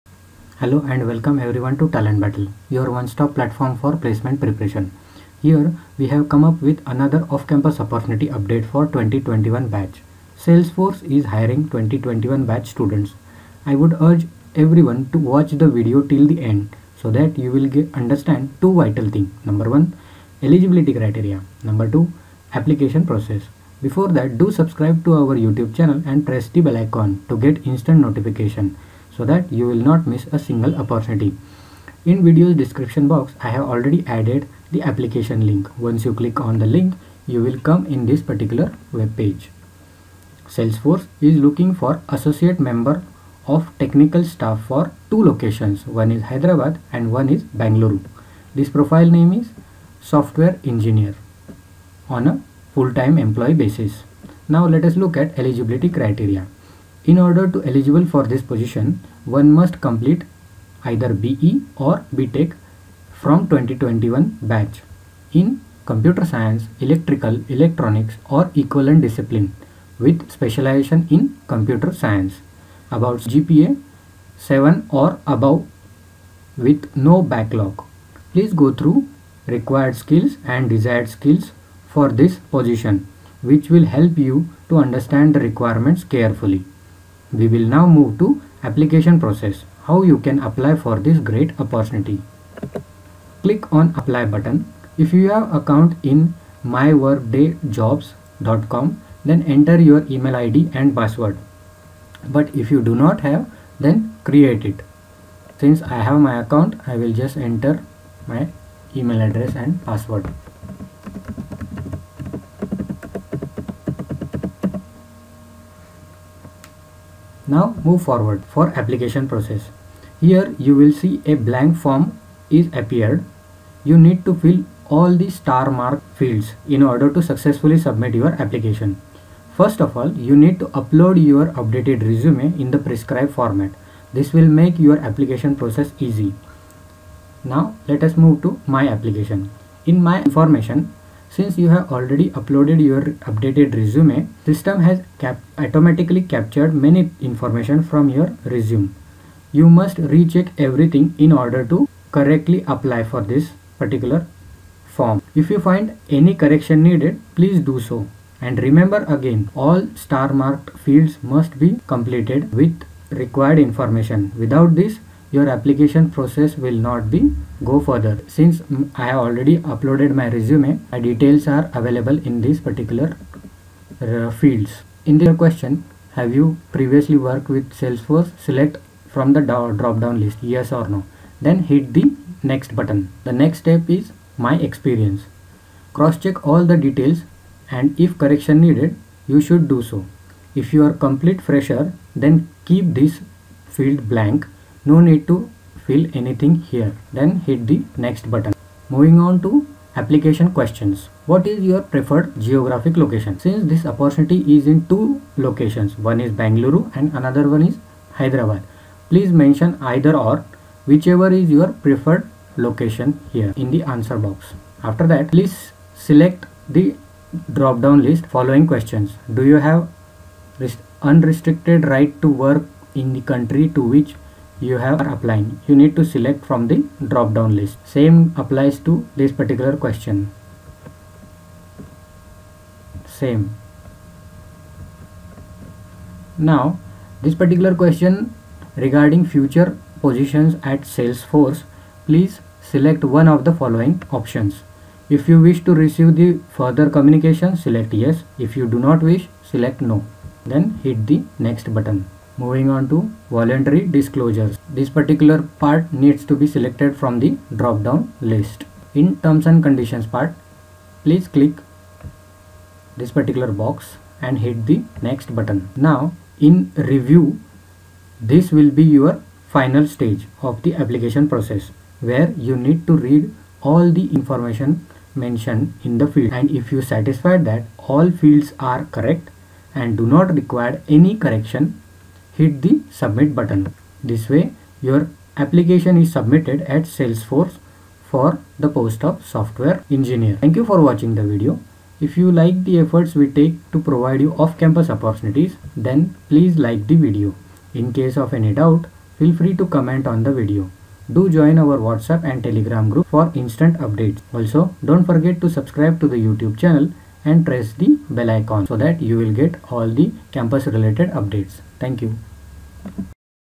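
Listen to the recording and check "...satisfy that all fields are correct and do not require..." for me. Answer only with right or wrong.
right.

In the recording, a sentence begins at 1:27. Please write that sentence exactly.
We will now move to application process, how you can apply for this great opportunity.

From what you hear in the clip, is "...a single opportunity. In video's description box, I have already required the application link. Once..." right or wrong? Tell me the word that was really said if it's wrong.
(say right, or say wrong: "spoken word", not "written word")
wrong: "added", not "required".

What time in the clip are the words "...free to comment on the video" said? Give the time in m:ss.
4:59.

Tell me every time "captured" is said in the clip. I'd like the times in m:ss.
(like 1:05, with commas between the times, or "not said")
2:26.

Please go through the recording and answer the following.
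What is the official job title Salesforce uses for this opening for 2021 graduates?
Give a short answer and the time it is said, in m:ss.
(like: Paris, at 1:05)
Associate Member of Technical Staff, at 0:42.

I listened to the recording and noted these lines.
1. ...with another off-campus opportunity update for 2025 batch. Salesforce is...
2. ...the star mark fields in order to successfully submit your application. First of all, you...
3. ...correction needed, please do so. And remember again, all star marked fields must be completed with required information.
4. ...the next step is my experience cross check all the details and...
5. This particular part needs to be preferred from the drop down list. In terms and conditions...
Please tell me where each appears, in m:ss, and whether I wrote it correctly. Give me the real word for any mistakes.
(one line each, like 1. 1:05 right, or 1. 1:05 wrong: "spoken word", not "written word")
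1. 0:06 wrong: "2021", not "2025"
2. 2:05 right
3. 2:36 right
4. 3:03 right
5. 4:14 wrong: "selected", not "preferred".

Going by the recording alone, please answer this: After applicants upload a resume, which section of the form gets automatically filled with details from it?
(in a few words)
My Information.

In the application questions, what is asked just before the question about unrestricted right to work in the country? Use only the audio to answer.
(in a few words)
Preferred geographic location.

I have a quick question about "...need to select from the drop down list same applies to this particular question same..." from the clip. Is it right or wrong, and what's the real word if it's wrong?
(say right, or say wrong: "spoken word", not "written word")
right.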